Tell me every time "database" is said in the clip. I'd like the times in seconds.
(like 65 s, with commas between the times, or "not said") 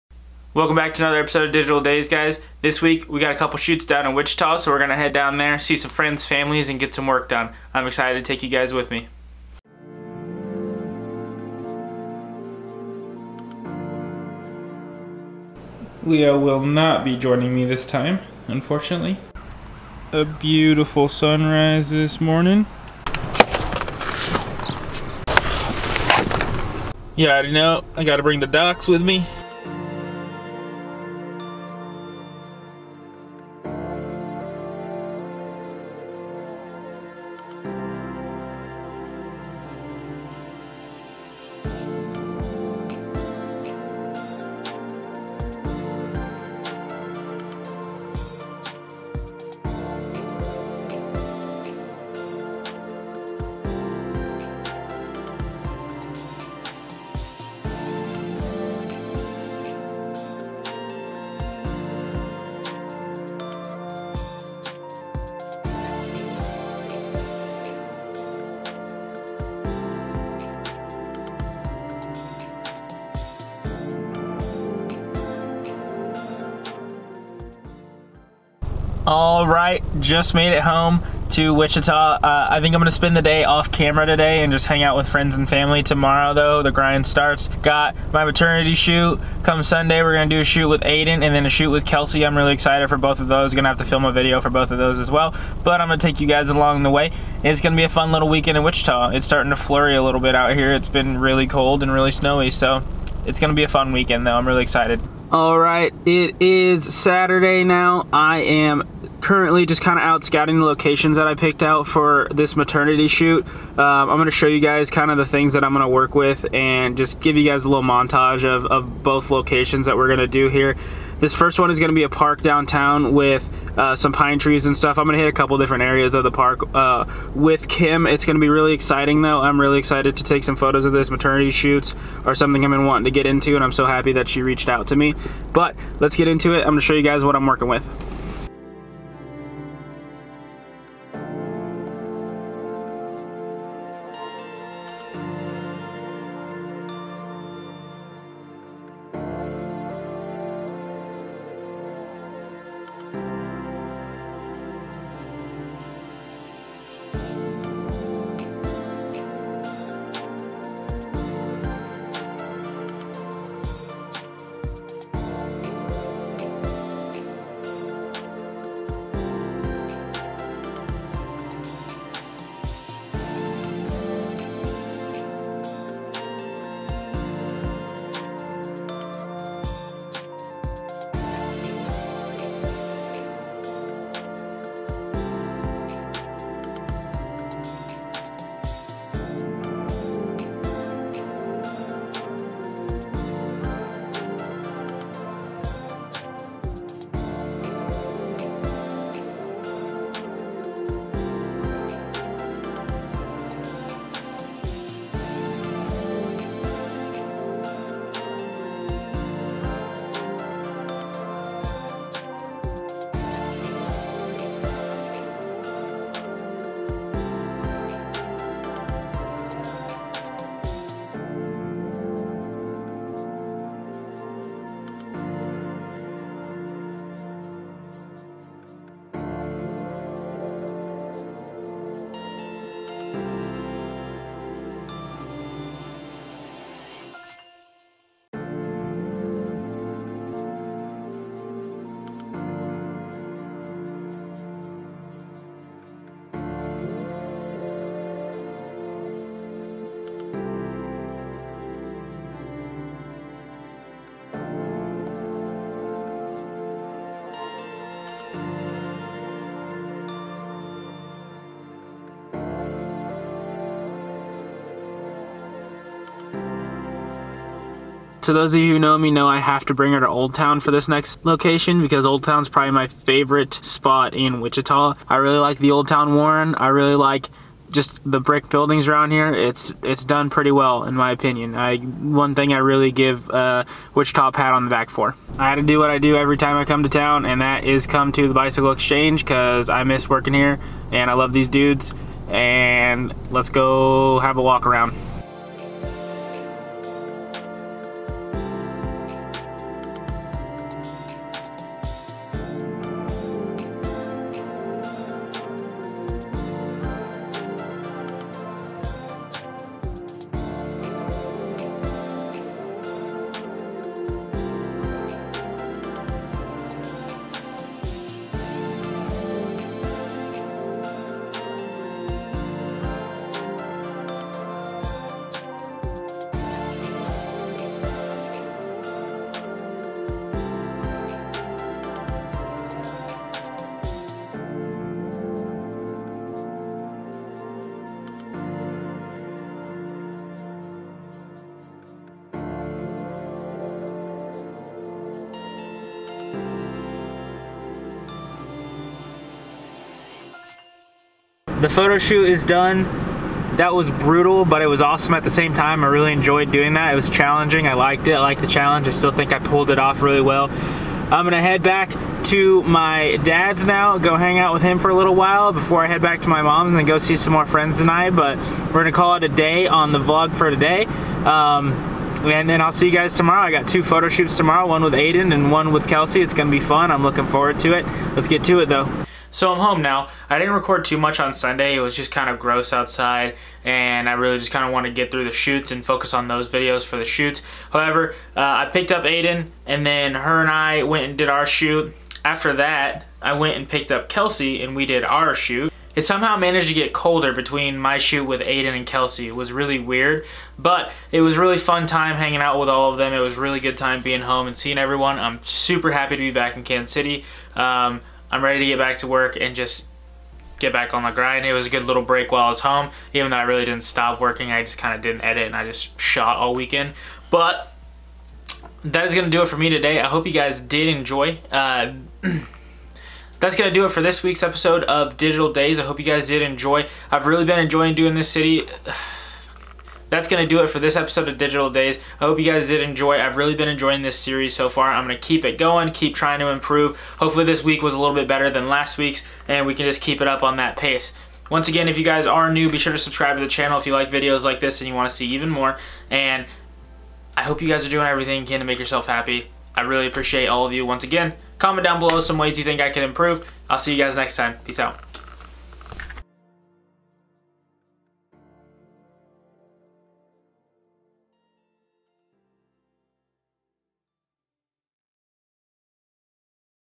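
not said.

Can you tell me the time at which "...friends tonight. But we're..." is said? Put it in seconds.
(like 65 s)
367 s.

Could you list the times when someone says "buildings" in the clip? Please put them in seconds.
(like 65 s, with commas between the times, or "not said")
278 s.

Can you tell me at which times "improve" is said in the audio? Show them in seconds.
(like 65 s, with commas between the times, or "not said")
436 s, 453 s.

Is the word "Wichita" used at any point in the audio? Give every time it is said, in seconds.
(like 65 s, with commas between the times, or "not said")
4 s, 81 s, 98 s, 274 s, 283 s.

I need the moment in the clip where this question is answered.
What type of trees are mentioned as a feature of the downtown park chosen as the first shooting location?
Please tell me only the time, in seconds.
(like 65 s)
124 s.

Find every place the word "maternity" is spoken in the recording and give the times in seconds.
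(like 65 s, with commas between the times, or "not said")
88 s, 112 s, 131 s.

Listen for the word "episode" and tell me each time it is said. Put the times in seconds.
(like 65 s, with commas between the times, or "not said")
1 s, 424 s, 430 s.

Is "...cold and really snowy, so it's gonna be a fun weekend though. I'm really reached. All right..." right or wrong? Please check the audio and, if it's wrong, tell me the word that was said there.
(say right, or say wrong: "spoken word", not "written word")
wrong: "excited", not "reached".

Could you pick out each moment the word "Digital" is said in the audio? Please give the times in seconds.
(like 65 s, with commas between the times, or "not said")
1 s, 425 s, 431 s.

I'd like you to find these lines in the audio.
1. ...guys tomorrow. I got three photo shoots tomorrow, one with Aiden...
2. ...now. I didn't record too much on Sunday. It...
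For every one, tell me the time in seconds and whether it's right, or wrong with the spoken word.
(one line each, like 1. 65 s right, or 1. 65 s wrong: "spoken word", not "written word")
1. 372 s wrong: "two", not "three"
2. 379 s right.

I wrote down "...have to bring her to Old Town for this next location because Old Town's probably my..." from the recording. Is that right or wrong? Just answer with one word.
right.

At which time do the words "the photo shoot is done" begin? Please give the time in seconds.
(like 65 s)
351 s.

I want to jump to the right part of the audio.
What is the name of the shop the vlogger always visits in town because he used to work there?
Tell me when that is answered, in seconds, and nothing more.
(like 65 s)
288 s.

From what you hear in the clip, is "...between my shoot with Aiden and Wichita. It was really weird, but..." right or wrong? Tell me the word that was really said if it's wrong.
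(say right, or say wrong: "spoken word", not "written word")
wrong: "Kelsey", not "Wichita".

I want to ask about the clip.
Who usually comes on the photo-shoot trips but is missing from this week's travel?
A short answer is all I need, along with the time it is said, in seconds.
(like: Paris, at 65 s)
Leo, at 16 s.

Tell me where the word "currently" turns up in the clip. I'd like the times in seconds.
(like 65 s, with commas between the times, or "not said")
109 s.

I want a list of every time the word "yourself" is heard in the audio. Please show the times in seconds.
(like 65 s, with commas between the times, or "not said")
448 s.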